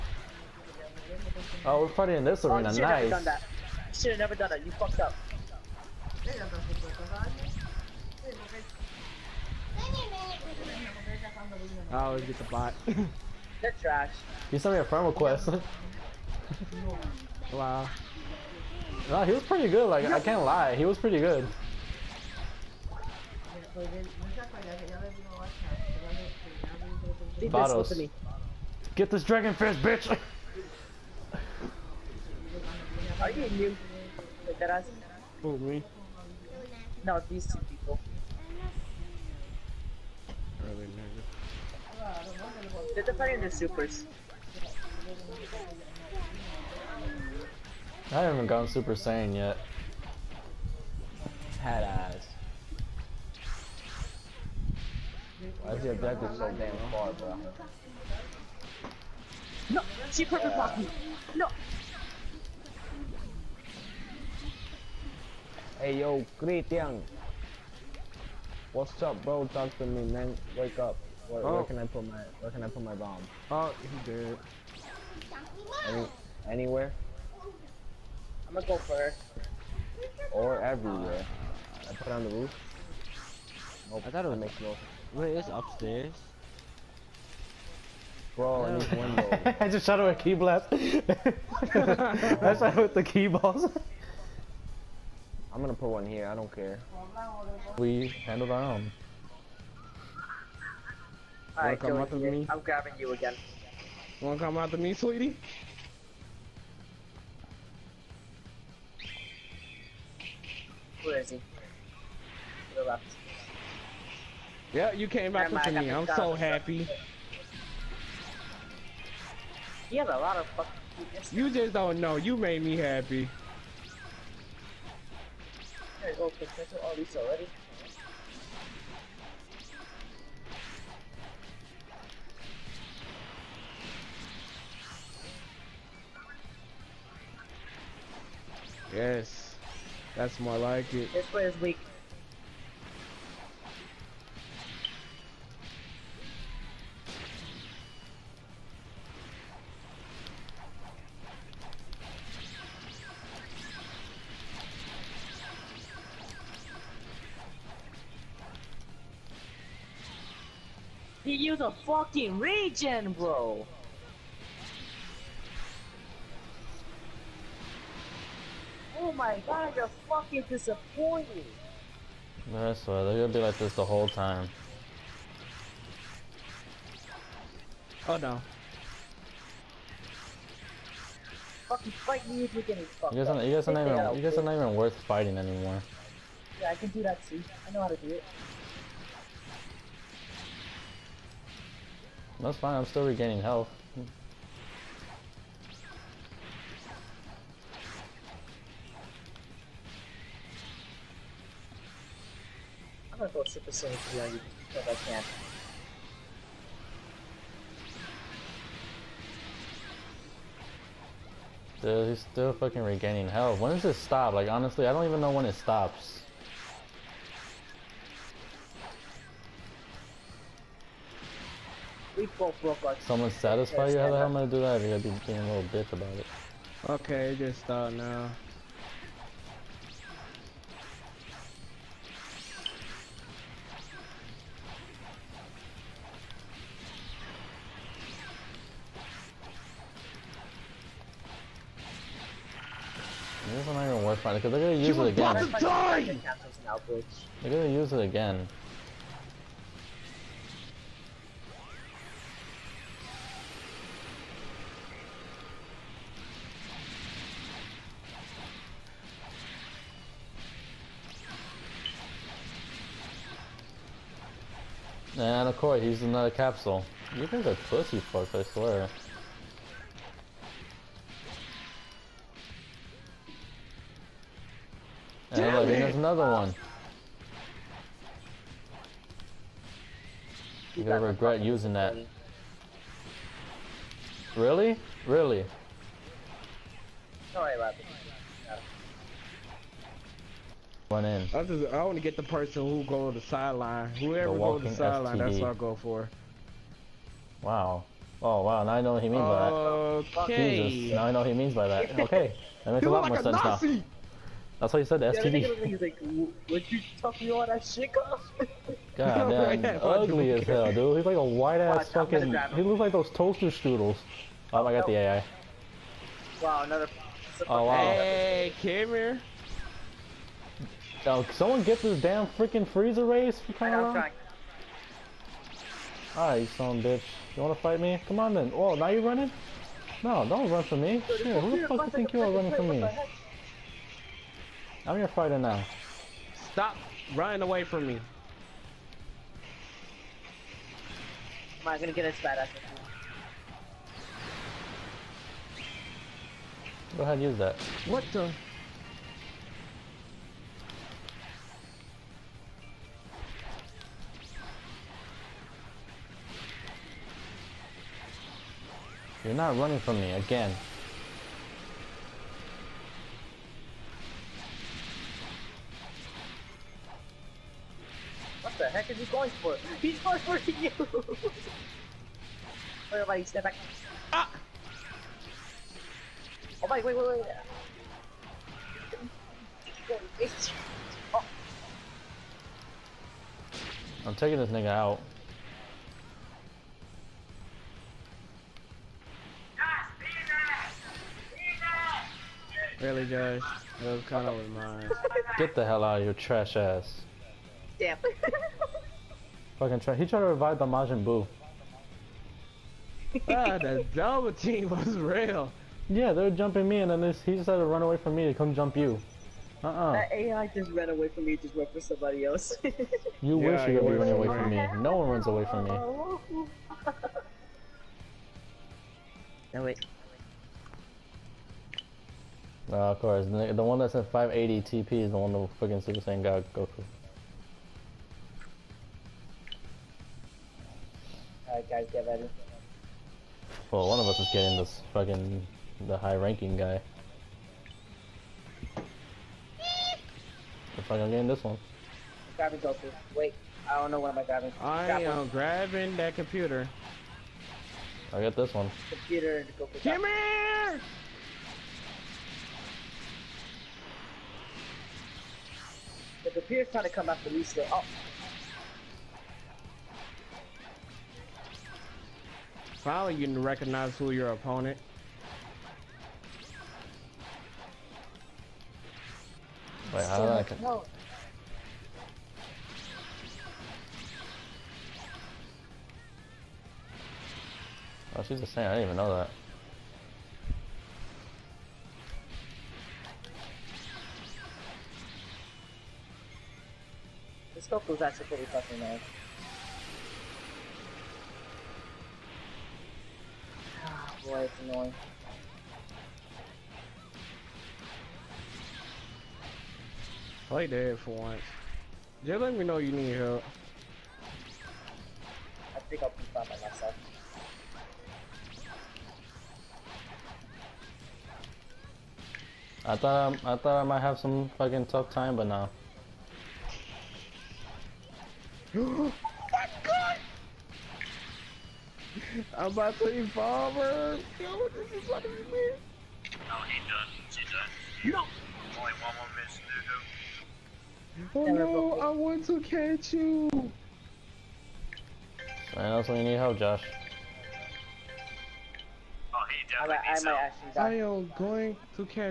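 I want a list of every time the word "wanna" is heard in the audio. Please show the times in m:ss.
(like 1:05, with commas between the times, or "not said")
1:44, 5:27.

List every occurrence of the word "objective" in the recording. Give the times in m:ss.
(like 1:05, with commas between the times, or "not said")
0:55.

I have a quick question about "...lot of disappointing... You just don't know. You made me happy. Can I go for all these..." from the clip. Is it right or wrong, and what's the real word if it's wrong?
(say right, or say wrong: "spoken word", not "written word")
wrong: "fucking", not "disappointing".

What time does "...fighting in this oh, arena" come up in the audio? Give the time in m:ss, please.
0:01.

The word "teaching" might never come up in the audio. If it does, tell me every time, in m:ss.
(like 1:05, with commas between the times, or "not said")
not said.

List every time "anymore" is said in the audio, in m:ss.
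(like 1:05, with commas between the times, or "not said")
3:05.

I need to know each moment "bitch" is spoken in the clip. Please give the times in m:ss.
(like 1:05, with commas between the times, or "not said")
0:29, 3:45, 5:26.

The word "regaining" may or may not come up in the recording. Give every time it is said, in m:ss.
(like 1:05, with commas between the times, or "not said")
3:13, 3:32.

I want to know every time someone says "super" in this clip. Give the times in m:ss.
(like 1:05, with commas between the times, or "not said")
0:43, 0:48, 3:23, 7:05.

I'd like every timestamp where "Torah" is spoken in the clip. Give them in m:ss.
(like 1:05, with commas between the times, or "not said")
not said.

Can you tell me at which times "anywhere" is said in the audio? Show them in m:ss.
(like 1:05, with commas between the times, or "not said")
1:16.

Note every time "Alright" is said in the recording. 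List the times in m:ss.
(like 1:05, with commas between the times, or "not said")
1:41, 5:26, 7:11.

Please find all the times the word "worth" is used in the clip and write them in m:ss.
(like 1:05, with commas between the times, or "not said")
3:04, 4:04.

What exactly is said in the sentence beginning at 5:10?
He's like a white ass fucking.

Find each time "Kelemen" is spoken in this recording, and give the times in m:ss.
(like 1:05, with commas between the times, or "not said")
not said.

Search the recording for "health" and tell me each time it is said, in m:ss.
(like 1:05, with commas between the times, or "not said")
3:13, 3:33.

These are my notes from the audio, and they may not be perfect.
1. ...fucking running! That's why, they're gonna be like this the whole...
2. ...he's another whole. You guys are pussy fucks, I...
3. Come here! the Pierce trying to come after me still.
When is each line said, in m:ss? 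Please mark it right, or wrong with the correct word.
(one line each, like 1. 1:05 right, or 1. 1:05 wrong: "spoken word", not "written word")
1. 2:50 wrong: "disappointing", not "running"
2. 4:25 wrong: "capsule", not "whole"
3. 7:29 right.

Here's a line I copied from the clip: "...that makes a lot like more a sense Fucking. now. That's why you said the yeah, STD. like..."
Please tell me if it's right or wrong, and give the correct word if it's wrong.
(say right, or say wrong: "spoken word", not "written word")
wrong: "Nazi", not "Fucking".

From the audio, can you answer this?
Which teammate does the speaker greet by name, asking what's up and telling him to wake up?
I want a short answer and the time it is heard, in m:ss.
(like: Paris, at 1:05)
Christian, at 1:06.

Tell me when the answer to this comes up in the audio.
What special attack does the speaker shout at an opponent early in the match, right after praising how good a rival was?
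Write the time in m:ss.
0:29.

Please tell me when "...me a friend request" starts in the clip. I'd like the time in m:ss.
0:14.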